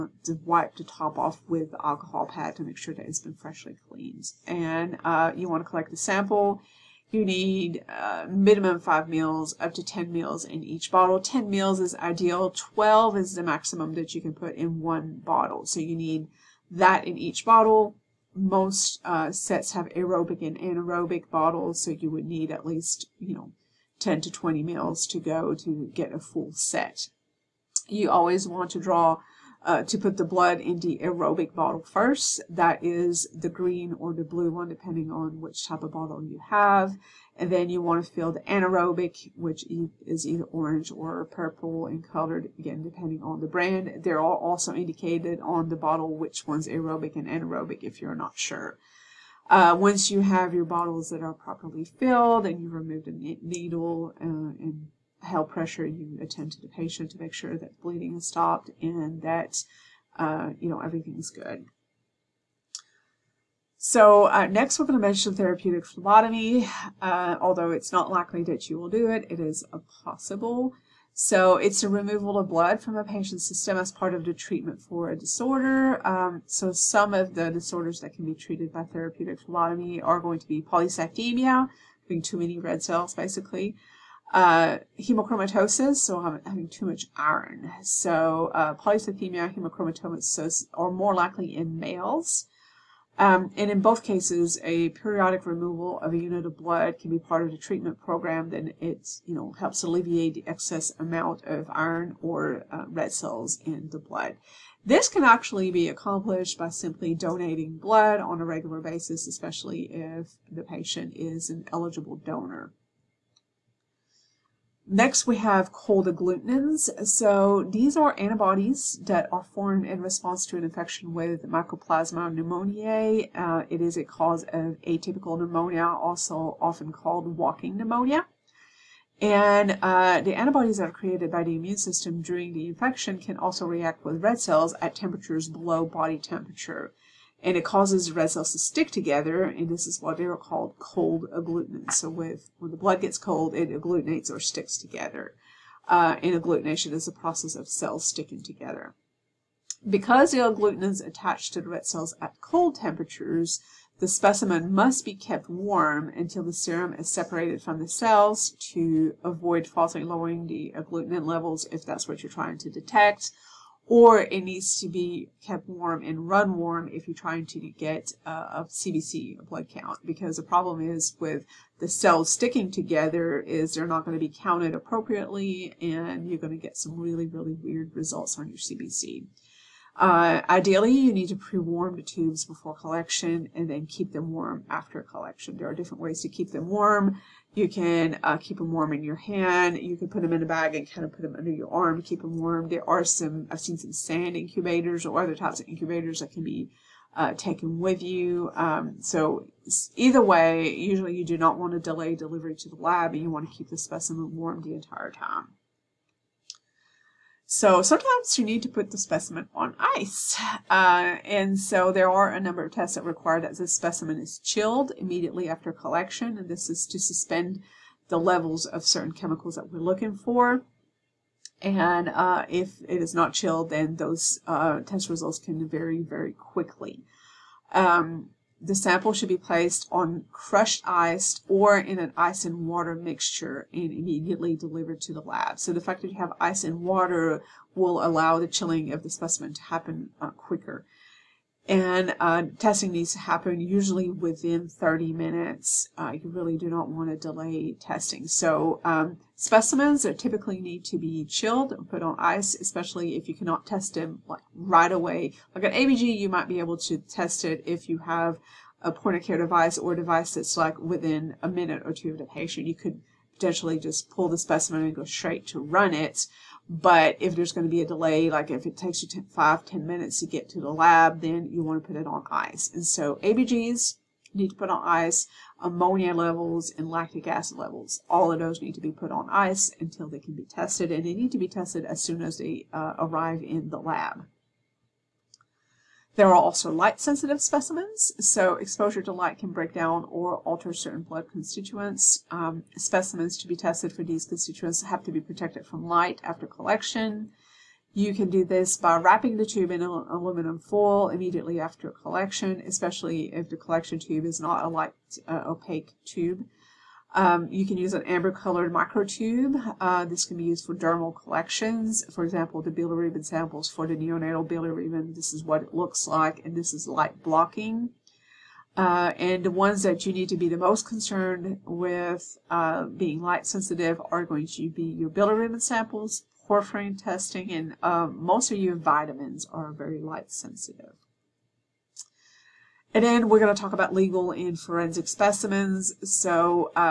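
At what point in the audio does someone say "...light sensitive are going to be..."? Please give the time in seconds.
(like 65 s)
323 s.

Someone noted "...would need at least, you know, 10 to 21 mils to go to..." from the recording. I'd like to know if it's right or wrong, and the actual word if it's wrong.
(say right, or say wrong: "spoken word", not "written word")
wrong: "20", not "21".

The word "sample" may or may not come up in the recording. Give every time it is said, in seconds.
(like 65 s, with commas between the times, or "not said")
5 s, 228 s, 313 s, 325 s.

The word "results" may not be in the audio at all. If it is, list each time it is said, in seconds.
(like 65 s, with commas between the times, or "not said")
177 s, 225 s.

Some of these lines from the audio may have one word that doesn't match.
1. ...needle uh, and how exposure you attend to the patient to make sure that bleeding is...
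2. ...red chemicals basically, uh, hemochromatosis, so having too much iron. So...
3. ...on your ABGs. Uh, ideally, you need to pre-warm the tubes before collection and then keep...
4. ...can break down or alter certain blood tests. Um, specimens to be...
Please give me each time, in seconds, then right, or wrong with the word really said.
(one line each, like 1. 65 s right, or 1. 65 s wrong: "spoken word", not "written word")
1. 53 s wrong: "pressure", not "exposure"
2. 82 s wrong: "cells", not "chemicals"
3. 178 s wrong: "CBC", not "ABGs"
4. 289 s wrong: "constituents", not "tests".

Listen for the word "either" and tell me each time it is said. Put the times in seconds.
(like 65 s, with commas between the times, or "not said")
40 s, 199 s.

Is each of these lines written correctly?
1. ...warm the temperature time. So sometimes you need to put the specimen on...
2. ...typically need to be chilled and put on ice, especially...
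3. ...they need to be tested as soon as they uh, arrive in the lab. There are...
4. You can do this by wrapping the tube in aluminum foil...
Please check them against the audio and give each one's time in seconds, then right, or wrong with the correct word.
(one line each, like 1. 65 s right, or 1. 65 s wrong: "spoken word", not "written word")
1. 204 s wrong: "entire", not "temperature"
2. 250 s right
3. 281 s right
4. 297 s right.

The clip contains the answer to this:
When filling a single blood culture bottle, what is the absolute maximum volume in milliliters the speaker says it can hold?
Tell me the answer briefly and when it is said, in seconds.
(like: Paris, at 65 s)
12, at 12 s.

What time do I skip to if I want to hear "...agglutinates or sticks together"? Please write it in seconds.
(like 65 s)
143 s.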